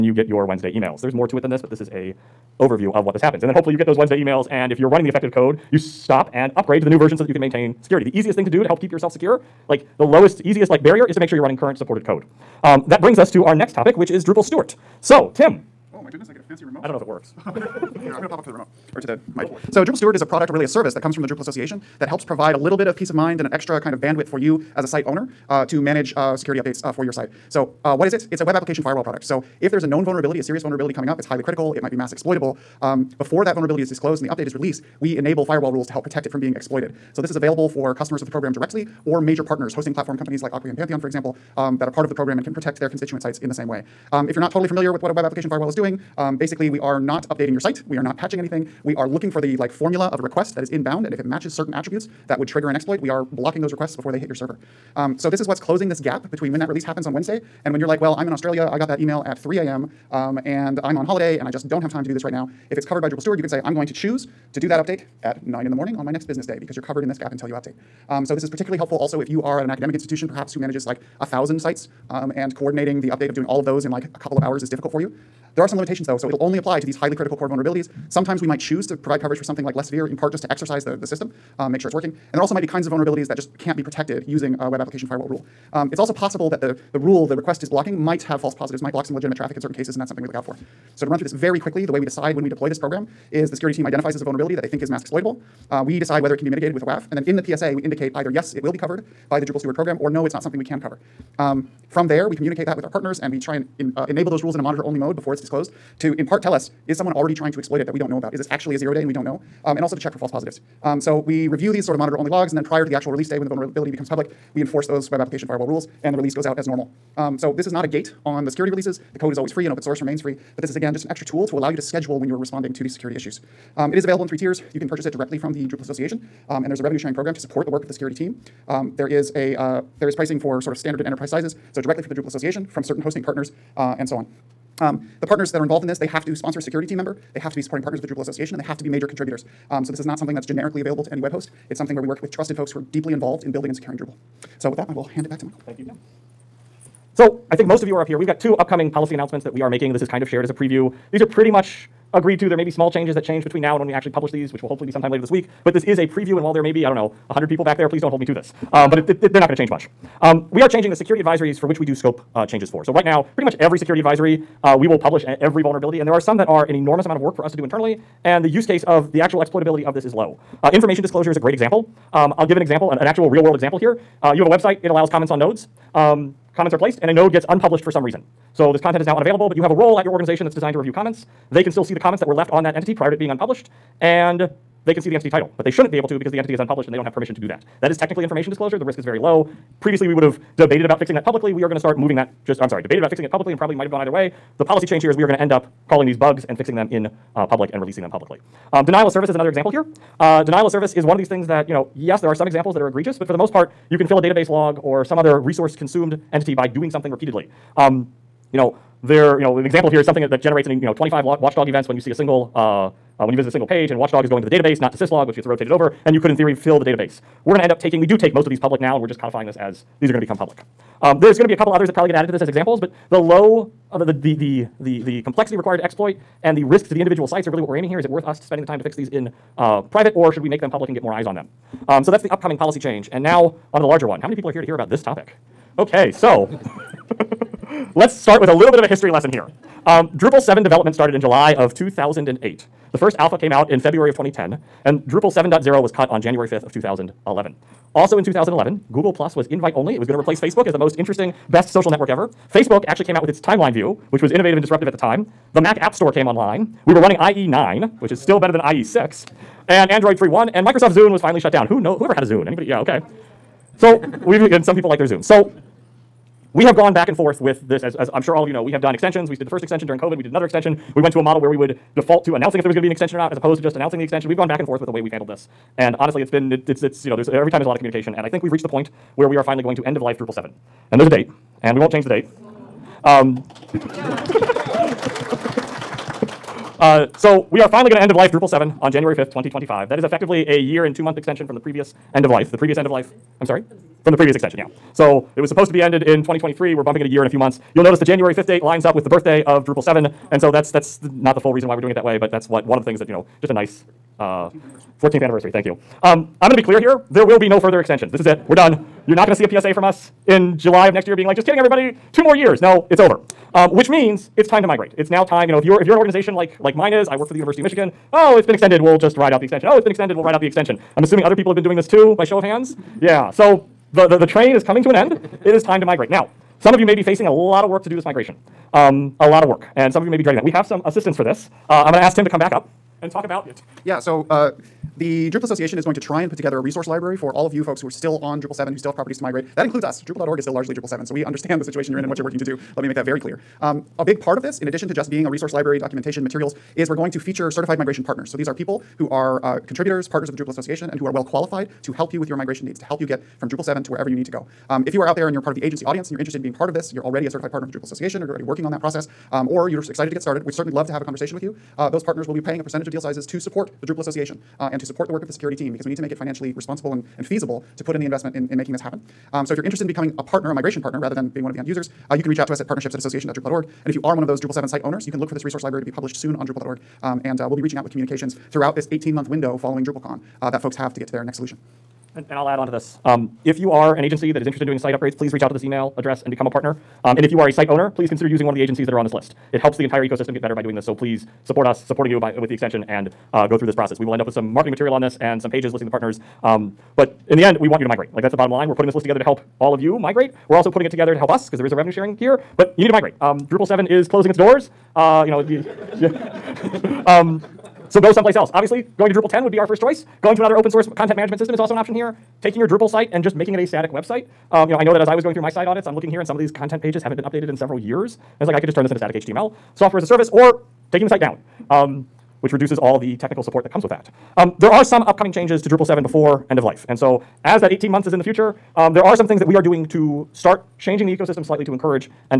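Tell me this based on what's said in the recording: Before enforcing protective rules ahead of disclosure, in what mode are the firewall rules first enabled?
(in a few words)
Monitor only mode.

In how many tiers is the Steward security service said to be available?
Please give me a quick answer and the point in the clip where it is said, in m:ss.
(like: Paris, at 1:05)
3, at 2:04.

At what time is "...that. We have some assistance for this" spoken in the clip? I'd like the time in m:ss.
5:30.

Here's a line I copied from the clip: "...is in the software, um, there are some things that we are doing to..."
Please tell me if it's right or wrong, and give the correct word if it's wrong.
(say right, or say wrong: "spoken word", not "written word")
wrong: "future", not "software".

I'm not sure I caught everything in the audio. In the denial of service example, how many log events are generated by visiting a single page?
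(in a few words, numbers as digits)
25.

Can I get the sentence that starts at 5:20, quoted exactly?
I'm assuming other people have been doing this too by show of hands.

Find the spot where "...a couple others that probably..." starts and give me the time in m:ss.
3:41.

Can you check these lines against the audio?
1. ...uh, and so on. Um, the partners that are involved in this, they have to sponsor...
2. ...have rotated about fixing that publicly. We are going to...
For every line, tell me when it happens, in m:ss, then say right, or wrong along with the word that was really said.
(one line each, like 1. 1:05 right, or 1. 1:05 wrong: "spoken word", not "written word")
1. 2:13 right
2. 3:10 wrong: "debated", not "rotated".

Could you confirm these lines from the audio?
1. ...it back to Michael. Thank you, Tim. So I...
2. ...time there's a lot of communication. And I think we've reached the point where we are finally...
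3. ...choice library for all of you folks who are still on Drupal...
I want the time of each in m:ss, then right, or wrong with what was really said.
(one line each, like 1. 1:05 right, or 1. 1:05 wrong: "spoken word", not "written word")
1. 2:25 right
2. 4:37 right
3. 5:36 wrong: "resource", not "choice".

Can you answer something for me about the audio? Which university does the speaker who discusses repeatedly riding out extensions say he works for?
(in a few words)
University of Michigan.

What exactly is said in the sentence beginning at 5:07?
There will be no further extensions.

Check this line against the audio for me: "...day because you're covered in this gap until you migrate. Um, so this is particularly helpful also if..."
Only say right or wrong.
wrong.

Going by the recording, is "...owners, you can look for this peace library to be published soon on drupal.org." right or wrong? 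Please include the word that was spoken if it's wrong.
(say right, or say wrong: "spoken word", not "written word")
wrong: "resource", not "peace".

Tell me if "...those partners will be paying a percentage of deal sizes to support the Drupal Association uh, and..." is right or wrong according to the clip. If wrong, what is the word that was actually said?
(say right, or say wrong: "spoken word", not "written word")
right.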